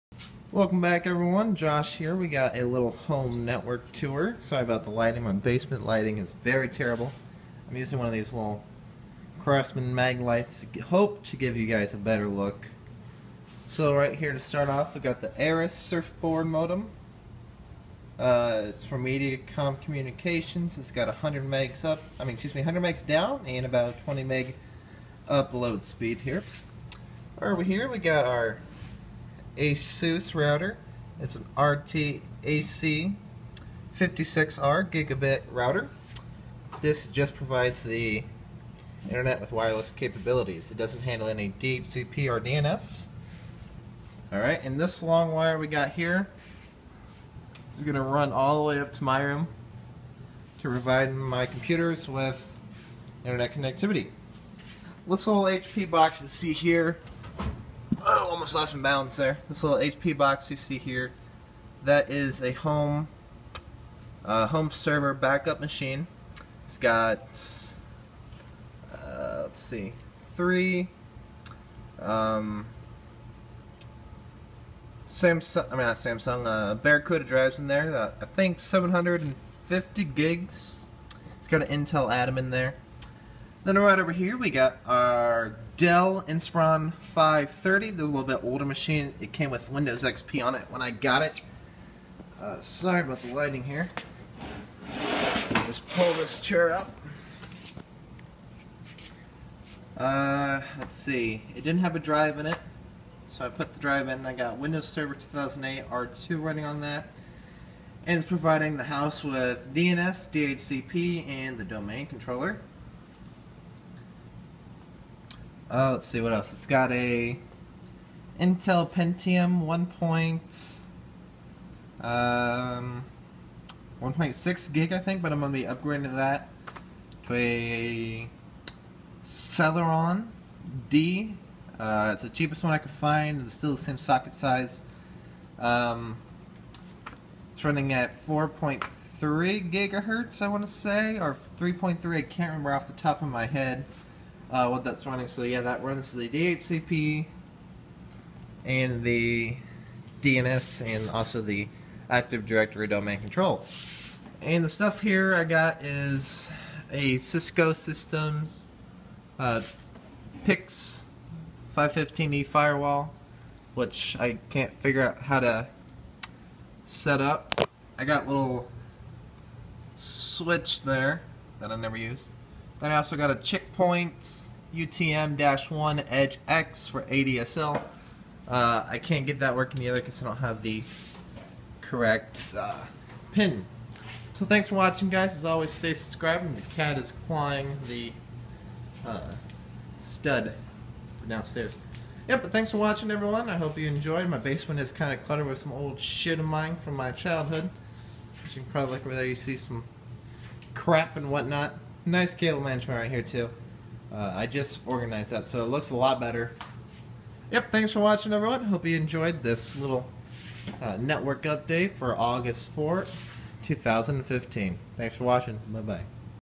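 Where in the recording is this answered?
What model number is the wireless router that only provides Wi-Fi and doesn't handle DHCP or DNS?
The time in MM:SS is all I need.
00:31.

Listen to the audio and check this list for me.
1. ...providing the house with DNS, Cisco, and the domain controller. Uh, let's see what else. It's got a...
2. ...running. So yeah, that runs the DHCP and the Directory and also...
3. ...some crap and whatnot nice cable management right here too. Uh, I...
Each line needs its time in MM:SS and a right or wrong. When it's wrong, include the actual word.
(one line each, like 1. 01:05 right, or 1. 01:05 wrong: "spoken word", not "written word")
1. 01:48 wrong: "DHCP", not "Cisco"
2. 02:25 wrong: "DNS", not "Directory"
3. 03:19 right.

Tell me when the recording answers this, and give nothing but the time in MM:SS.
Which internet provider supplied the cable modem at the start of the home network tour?
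00:19.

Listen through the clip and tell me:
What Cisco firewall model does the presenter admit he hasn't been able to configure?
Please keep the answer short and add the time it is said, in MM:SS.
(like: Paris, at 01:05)
PIX 515E, at 02:40.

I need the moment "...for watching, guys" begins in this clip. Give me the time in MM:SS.
03:04.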